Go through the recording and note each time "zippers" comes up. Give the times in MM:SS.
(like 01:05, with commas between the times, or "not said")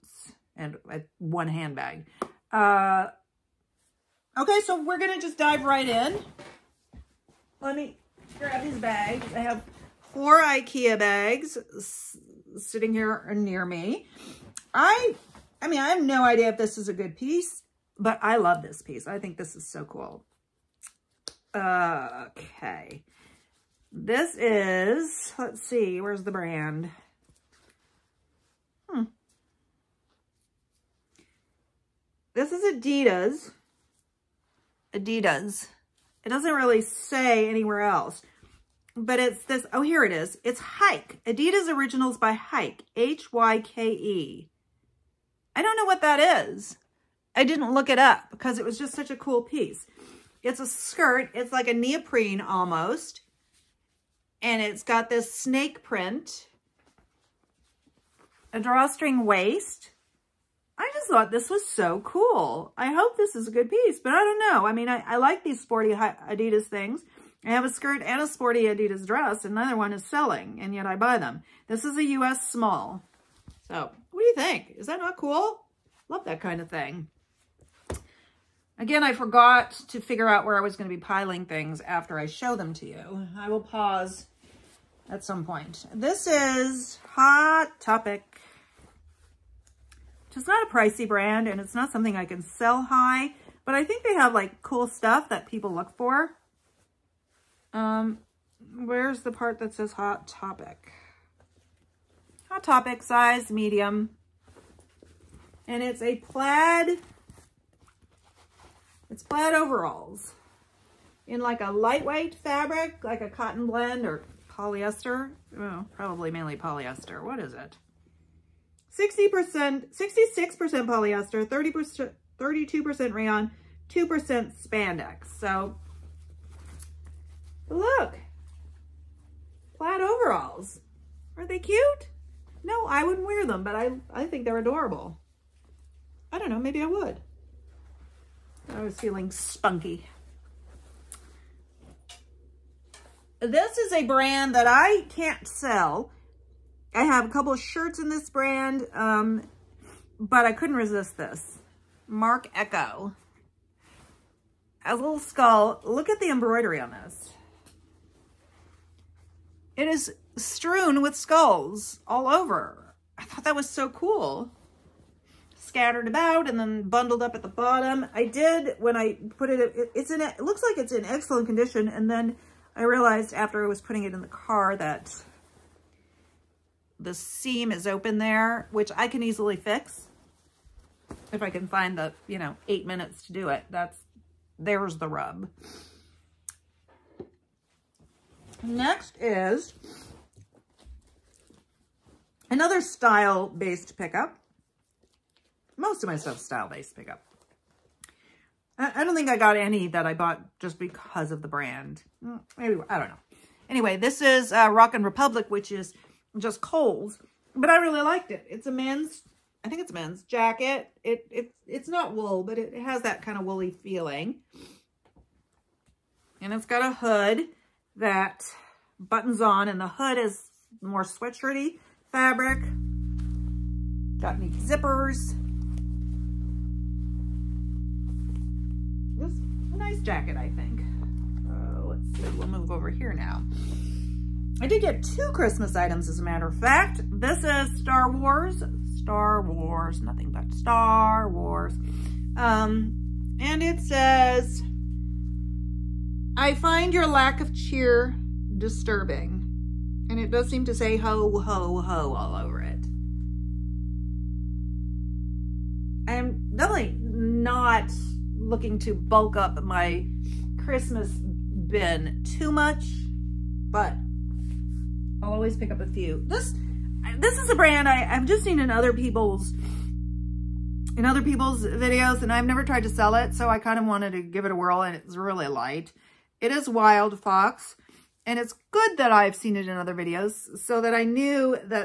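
03:44.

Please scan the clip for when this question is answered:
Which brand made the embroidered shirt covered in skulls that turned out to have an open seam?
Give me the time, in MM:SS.
02:32.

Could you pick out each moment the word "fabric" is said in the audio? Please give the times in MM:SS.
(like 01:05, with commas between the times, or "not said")
01:52, 03:42.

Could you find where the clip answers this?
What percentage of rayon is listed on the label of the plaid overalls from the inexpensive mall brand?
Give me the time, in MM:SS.
02:02.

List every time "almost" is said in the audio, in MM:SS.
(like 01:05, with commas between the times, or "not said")
00:52.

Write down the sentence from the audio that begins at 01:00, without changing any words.
I just thought this was so cool.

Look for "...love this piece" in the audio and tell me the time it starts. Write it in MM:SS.
00:18.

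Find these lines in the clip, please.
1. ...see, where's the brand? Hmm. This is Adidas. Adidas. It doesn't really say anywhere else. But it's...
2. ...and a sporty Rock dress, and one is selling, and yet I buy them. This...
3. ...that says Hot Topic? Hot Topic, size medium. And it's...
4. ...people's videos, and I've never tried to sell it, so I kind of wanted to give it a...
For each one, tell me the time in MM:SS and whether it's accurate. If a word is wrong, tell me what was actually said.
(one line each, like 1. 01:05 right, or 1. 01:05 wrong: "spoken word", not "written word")
1. 00:25 right
2. 01:08 wrong: "Adidas", not "Rock"
3. 01:39 right
4. 04:31 right.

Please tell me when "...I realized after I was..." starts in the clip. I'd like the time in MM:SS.
02:52.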